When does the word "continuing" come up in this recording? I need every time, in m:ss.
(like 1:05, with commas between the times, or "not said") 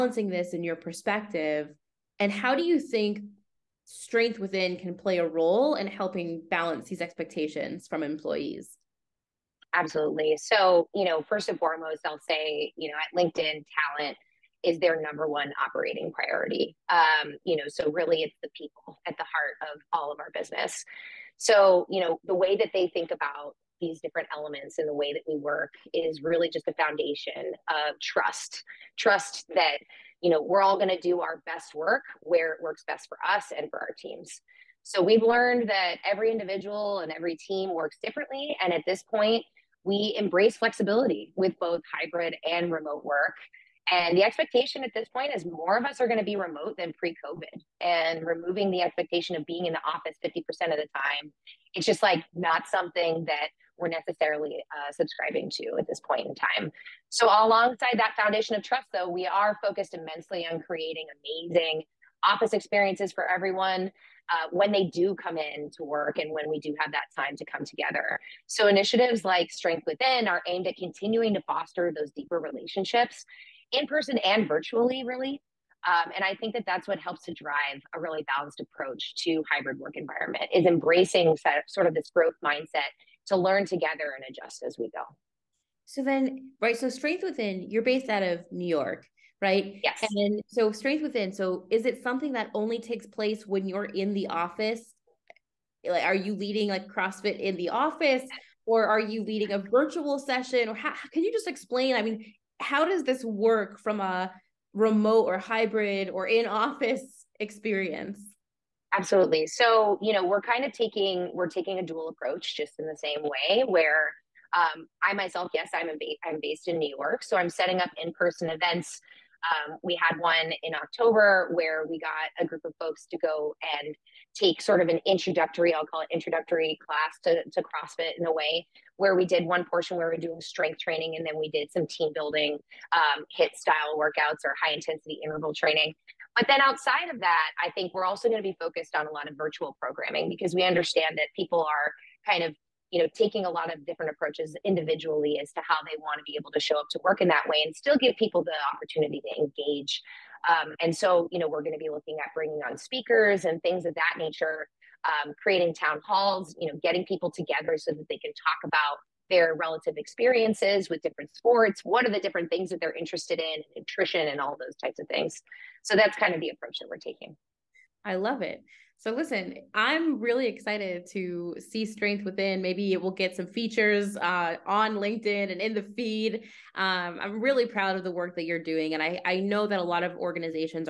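1:10.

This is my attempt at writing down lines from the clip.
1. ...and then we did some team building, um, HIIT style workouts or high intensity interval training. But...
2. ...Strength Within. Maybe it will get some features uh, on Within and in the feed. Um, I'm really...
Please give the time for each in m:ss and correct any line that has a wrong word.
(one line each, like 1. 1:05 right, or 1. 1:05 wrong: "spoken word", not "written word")
1. 2:11 right
2. 2:51 wrong: "LinkedIn", not "Within".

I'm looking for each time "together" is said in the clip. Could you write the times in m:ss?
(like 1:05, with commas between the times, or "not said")
1:07, 1:23, 2:37.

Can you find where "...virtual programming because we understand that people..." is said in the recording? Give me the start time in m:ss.
2:19.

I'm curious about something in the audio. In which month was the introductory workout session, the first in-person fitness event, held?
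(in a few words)
October.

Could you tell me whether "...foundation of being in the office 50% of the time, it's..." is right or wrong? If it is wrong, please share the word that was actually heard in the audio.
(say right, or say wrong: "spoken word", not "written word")
wrong: "expectation", not "foundation".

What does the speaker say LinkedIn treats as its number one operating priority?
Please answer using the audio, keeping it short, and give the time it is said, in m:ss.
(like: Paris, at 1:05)
Talent, at 0:13.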